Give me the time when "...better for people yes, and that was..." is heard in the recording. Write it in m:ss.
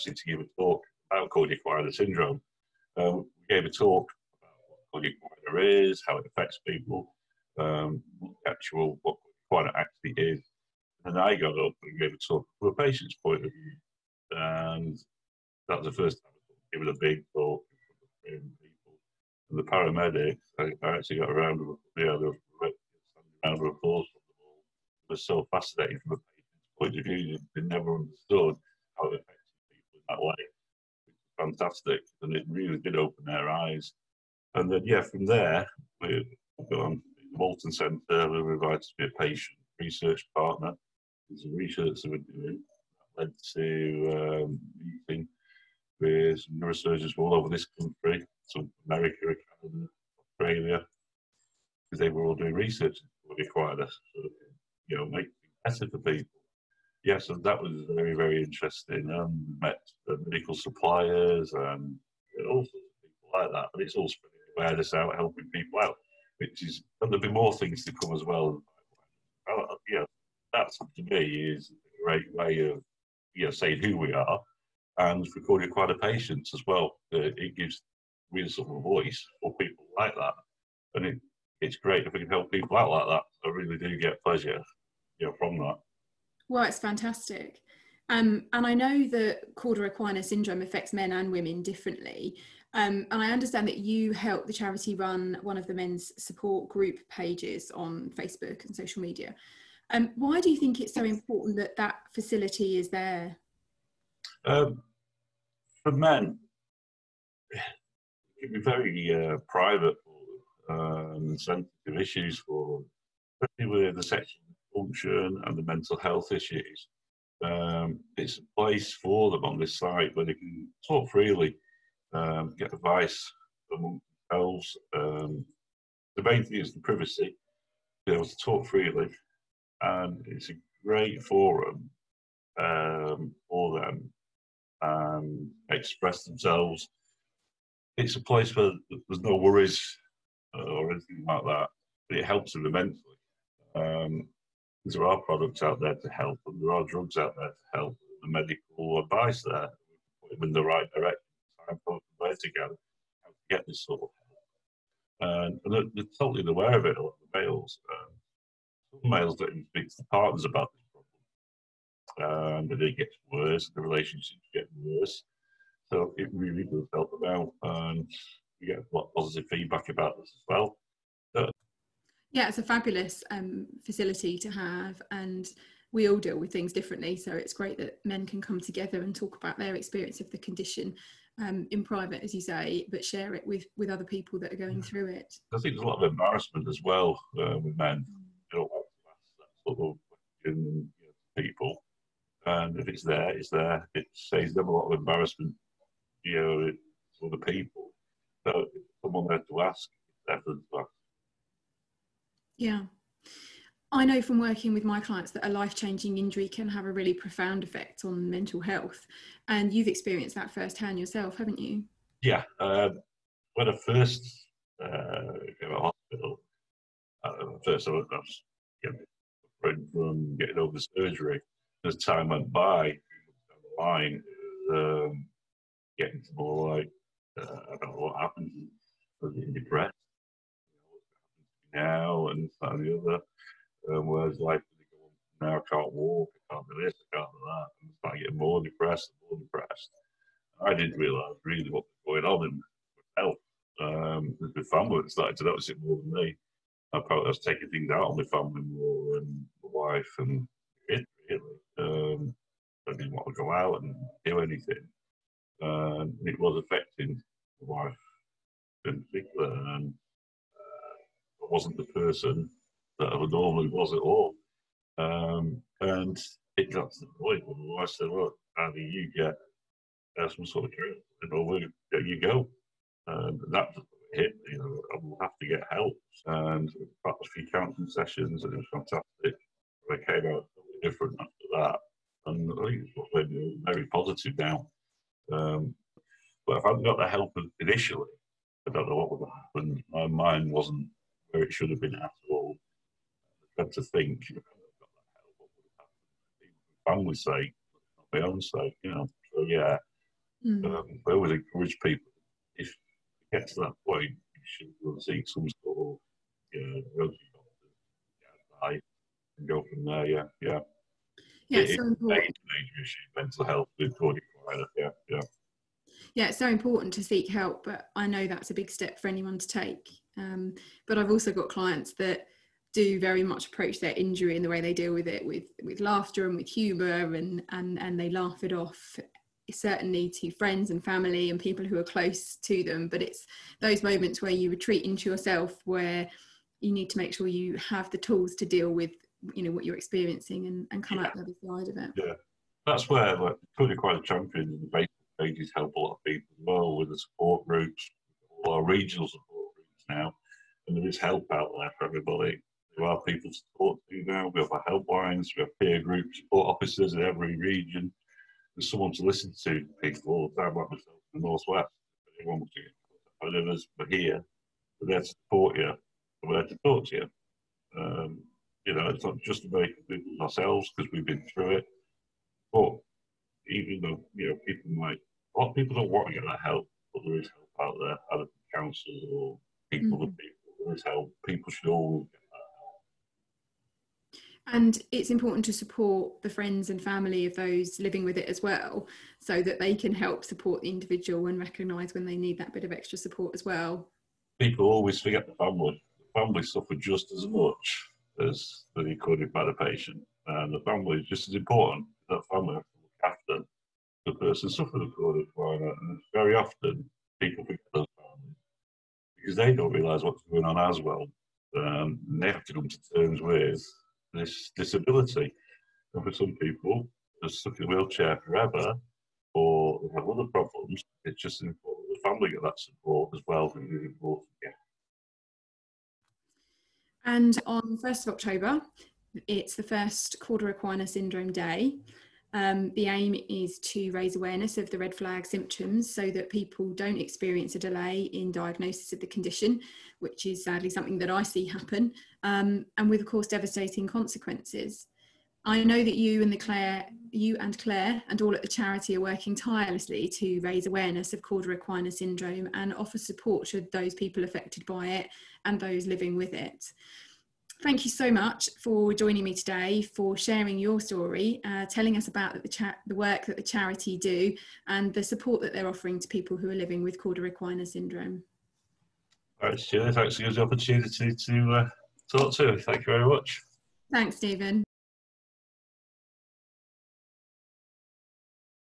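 0:55.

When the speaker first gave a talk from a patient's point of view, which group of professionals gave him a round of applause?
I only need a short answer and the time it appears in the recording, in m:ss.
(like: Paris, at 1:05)
Paramedics, at 0:19.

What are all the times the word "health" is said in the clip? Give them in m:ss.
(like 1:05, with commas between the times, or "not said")
1:55, 3:28, 4:03, 5:13.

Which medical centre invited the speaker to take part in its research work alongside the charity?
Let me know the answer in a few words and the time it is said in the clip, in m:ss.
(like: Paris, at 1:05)
Walton Centre, at 0:37.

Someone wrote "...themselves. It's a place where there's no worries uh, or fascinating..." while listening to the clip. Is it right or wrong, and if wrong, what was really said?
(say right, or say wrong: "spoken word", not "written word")
wrong: "anything", not "fascinating".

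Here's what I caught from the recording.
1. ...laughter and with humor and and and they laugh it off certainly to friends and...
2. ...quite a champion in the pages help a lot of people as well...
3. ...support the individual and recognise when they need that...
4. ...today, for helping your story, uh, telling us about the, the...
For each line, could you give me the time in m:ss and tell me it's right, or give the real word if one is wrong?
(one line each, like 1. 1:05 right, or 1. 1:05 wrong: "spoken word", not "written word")
1. 5:25 right
2. 5:43 right
3. 6:30 right
4. 7:39 wrong: "sharing", not "helping".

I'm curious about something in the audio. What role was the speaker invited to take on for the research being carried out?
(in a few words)
Patient research partner.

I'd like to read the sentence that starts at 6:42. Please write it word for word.
That family after the person suffered a chronic climate.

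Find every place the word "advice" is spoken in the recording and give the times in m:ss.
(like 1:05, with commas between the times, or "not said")
2:02, 2:28, 5:08.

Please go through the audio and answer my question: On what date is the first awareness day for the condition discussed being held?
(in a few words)
1 October.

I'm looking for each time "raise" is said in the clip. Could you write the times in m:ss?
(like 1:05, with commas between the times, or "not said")
7:13, 7:30.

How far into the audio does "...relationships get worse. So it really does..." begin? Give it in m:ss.
2:43.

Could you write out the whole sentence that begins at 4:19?
And I wasn't the person that I normally was at all.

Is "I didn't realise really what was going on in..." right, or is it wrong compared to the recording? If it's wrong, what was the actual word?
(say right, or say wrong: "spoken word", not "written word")
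right.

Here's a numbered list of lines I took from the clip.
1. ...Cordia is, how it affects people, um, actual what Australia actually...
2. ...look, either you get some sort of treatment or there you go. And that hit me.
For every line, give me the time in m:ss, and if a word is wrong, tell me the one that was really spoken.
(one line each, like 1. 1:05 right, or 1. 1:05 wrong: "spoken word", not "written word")
1. 0:05 wrong: "Cordia", not "Australia"
2. 4:28 right.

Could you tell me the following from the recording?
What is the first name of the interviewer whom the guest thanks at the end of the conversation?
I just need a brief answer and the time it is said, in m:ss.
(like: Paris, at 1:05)
Julie, at 7:49.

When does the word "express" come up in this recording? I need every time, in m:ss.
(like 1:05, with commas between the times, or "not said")
2:15.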